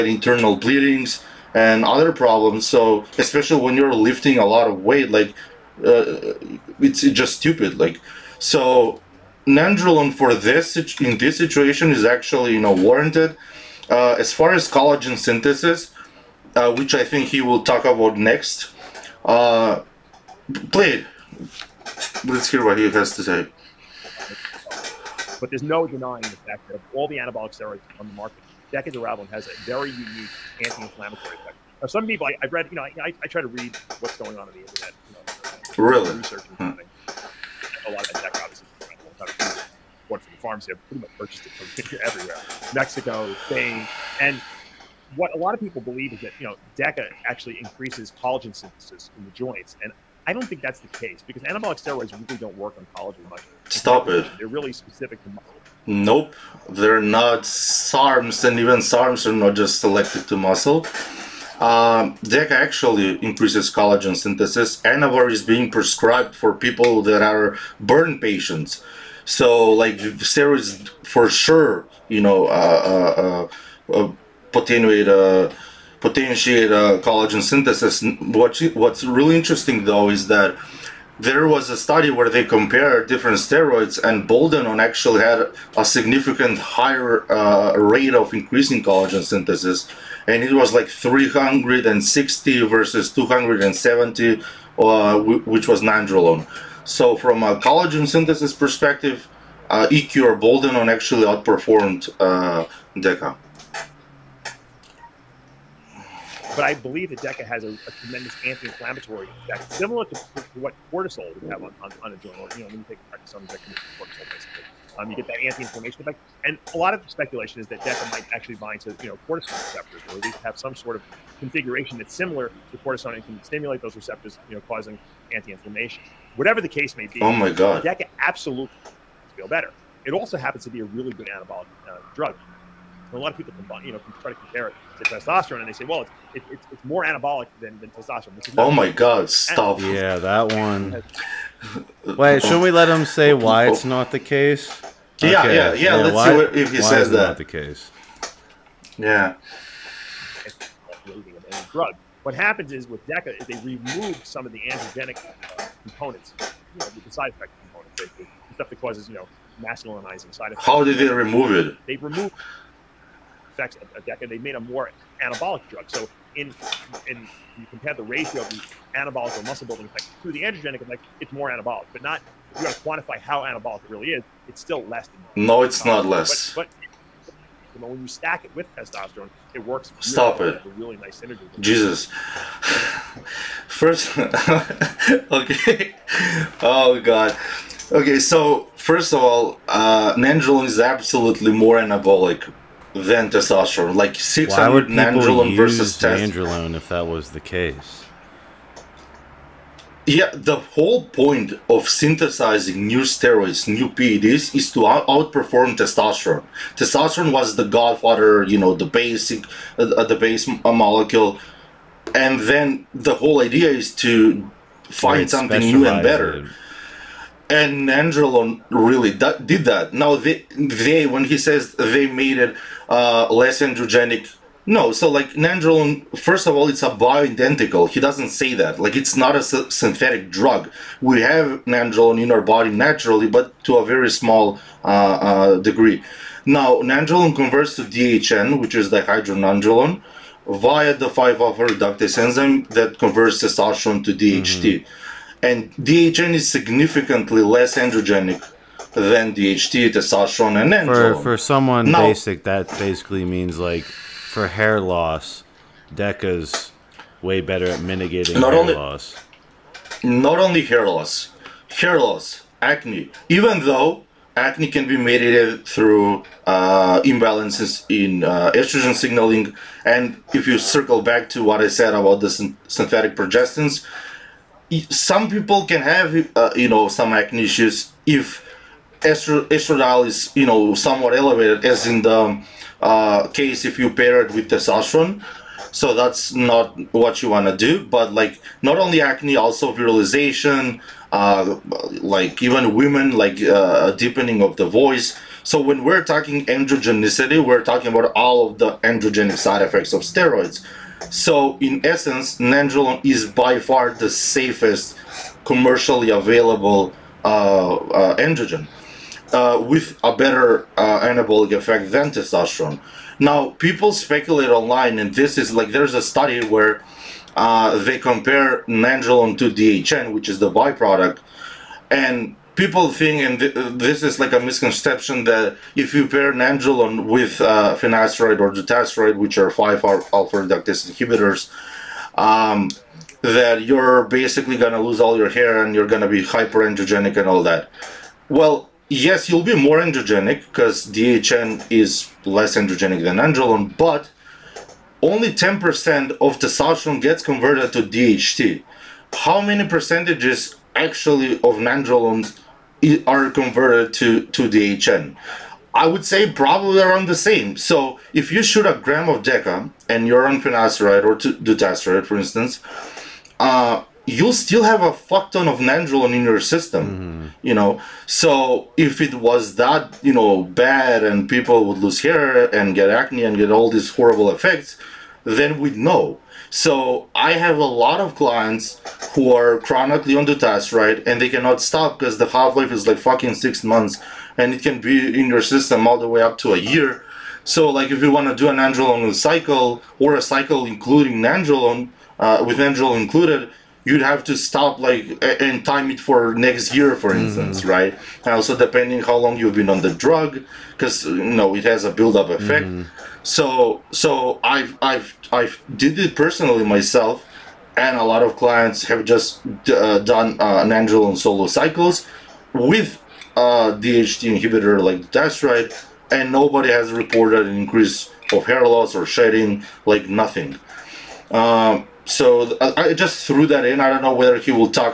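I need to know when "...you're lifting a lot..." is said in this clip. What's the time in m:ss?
0:03.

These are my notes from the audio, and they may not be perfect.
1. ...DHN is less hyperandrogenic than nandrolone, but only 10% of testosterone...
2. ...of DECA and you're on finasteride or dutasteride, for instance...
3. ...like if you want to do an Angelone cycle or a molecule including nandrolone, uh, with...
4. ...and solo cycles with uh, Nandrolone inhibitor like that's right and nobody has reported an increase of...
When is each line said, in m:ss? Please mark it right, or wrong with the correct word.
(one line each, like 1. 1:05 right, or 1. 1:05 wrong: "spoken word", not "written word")
1. 5:40 wrong: "androgenic", not "hyperandrogenic"
2. 5:59 right
3. 6:27 wrong: "cycle", not "molecule"
4. 6:51 wrong: "DHT", not "Nandrolone".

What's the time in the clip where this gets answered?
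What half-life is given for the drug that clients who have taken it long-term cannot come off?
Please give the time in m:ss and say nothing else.
6:23.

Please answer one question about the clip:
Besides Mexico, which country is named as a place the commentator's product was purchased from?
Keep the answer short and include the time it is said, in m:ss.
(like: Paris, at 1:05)
Spain, at 0:43.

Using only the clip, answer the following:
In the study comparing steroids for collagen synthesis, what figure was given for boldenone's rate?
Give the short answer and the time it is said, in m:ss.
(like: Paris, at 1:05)
360, at 1:30.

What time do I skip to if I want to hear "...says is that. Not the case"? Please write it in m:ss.
2:26.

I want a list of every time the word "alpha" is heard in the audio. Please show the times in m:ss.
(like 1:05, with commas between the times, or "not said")
4:01, 5:29.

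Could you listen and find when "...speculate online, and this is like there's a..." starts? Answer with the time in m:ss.
5:13.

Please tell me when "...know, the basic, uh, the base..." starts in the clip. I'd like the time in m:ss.
3:28.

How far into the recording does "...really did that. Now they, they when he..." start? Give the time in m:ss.
3:38.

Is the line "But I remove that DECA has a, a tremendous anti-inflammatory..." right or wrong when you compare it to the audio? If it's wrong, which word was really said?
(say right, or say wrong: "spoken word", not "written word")
wrong: "believe", not "remove".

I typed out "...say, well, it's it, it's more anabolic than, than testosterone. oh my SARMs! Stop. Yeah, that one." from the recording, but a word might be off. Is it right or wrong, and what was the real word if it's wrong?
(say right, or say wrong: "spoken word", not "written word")
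wrong: "God", not "SARMs".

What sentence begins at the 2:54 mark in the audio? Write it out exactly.
It's still less than no, it's not less.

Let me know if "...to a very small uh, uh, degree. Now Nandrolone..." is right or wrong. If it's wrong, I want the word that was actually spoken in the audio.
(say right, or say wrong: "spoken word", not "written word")
right.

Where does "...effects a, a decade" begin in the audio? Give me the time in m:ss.
2:43.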